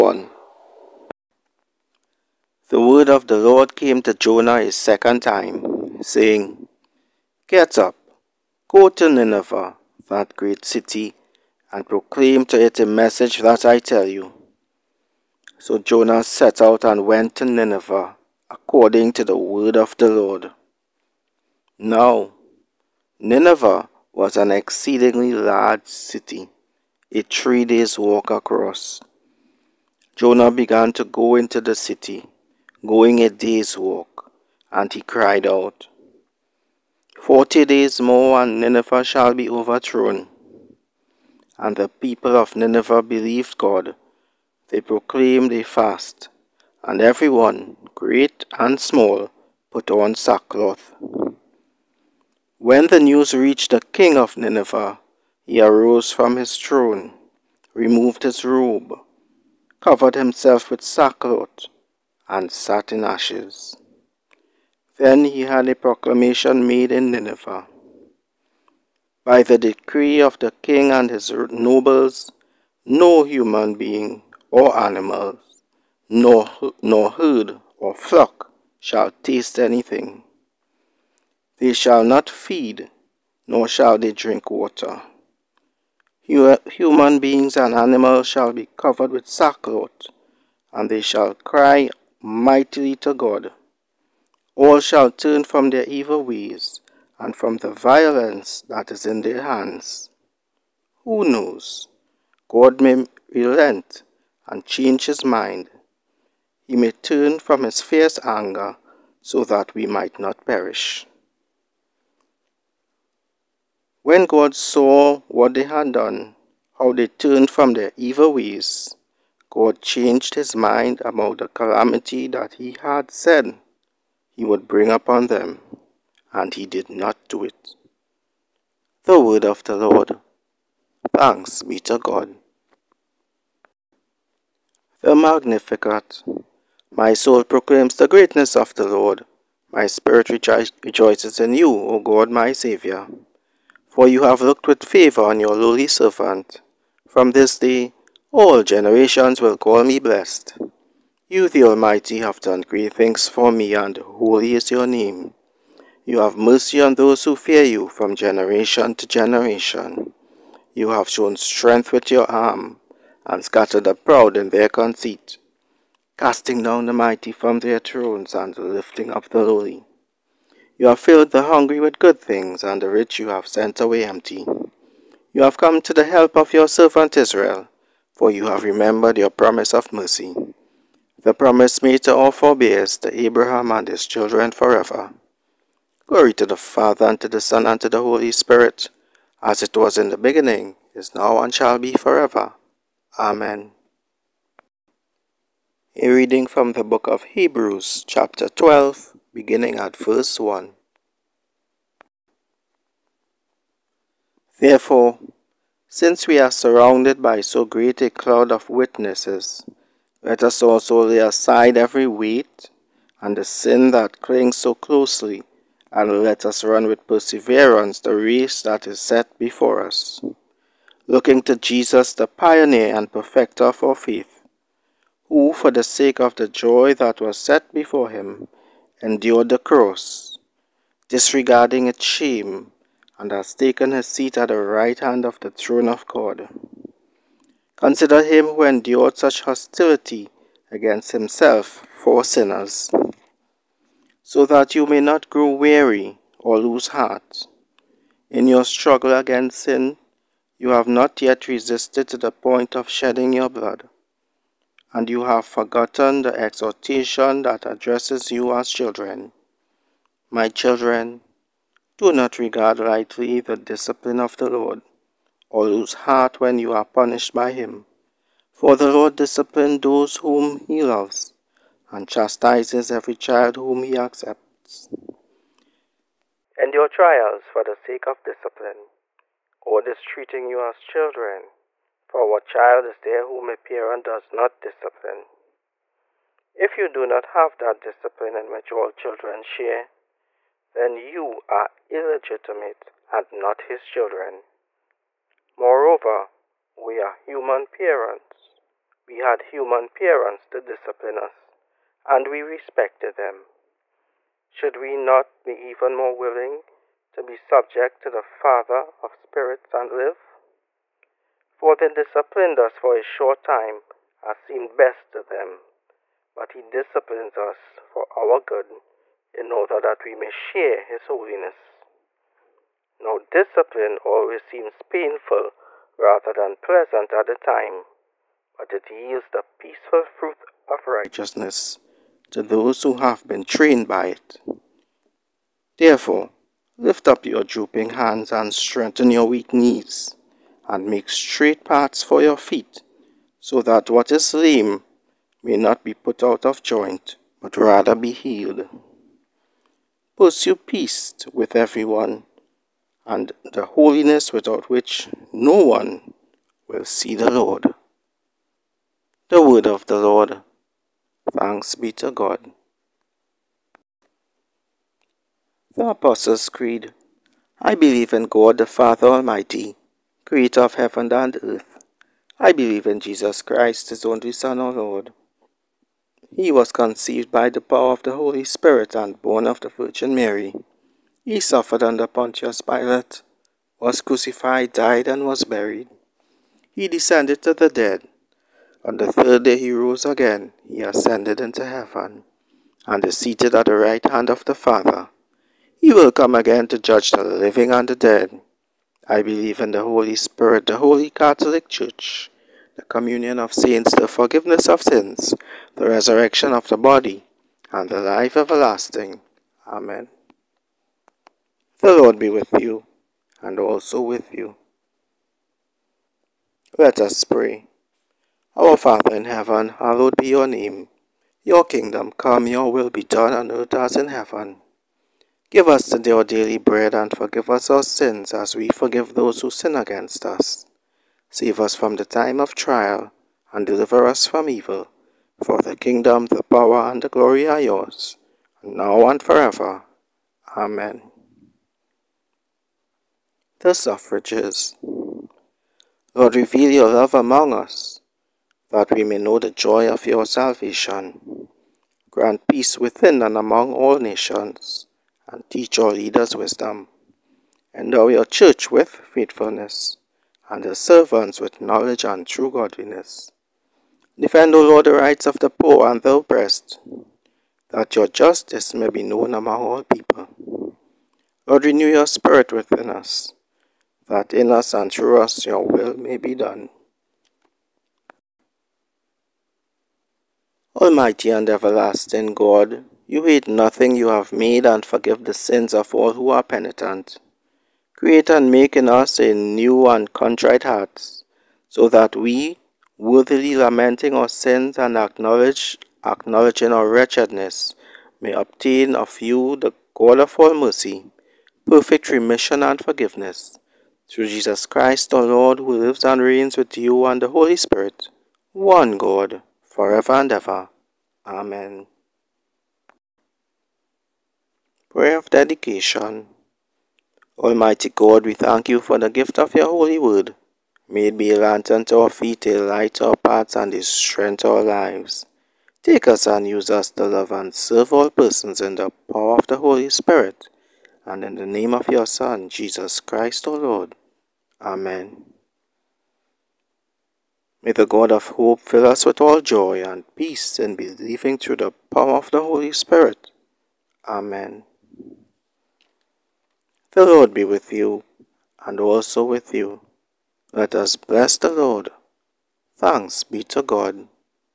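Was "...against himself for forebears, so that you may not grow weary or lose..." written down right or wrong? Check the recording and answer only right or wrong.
wrong.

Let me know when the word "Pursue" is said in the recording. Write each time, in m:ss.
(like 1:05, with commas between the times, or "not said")
5:50.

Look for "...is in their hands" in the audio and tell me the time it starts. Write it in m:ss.
1:38.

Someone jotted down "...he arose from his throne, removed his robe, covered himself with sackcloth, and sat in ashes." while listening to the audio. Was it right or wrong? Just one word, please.
right.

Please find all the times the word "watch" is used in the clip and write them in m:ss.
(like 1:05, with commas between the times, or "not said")
not said.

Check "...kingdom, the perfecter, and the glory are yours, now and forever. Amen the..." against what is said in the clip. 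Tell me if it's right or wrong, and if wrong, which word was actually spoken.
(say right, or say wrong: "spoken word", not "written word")
wrong: "power", not "perfecter".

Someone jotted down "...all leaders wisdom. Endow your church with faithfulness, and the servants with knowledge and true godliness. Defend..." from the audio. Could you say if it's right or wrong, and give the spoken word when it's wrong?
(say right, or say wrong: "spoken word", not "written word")
right.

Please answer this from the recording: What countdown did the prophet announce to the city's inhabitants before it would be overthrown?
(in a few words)
40 days.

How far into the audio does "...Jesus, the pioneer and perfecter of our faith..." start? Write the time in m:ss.
3:41.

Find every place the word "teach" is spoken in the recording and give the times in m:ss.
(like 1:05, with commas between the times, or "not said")
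7:35.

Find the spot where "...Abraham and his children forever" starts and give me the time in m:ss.
3:03.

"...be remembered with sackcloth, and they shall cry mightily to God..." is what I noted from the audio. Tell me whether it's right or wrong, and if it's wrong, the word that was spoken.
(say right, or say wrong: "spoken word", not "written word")
wrong: "covered", not "remembered".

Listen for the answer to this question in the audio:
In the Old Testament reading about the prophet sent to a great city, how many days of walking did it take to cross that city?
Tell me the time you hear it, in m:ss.
0:27.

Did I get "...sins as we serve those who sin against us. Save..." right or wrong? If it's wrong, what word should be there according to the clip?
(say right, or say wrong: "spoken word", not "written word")
wrong: "forgive", not "serve".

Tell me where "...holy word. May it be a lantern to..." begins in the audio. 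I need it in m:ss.
8:39.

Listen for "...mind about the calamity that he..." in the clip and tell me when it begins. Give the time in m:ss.
2:00.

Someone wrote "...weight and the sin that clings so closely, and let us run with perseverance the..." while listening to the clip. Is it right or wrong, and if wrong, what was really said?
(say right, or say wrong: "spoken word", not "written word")
right.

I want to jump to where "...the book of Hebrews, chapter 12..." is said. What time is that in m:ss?
3:16.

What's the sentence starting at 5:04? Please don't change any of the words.
Should we not be even more willing to be subject to the Father of spirits and live?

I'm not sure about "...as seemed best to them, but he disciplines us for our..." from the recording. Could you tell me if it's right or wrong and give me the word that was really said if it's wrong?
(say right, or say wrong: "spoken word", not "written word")
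right.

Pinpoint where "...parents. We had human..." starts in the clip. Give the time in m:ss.
4:57.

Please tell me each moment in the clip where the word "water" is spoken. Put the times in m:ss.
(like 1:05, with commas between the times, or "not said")
1:24.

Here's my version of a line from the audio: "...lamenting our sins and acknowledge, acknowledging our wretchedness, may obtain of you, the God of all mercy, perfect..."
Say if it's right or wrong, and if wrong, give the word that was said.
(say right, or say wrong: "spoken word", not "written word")
right.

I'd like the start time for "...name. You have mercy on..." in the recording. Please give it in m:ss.
2:34.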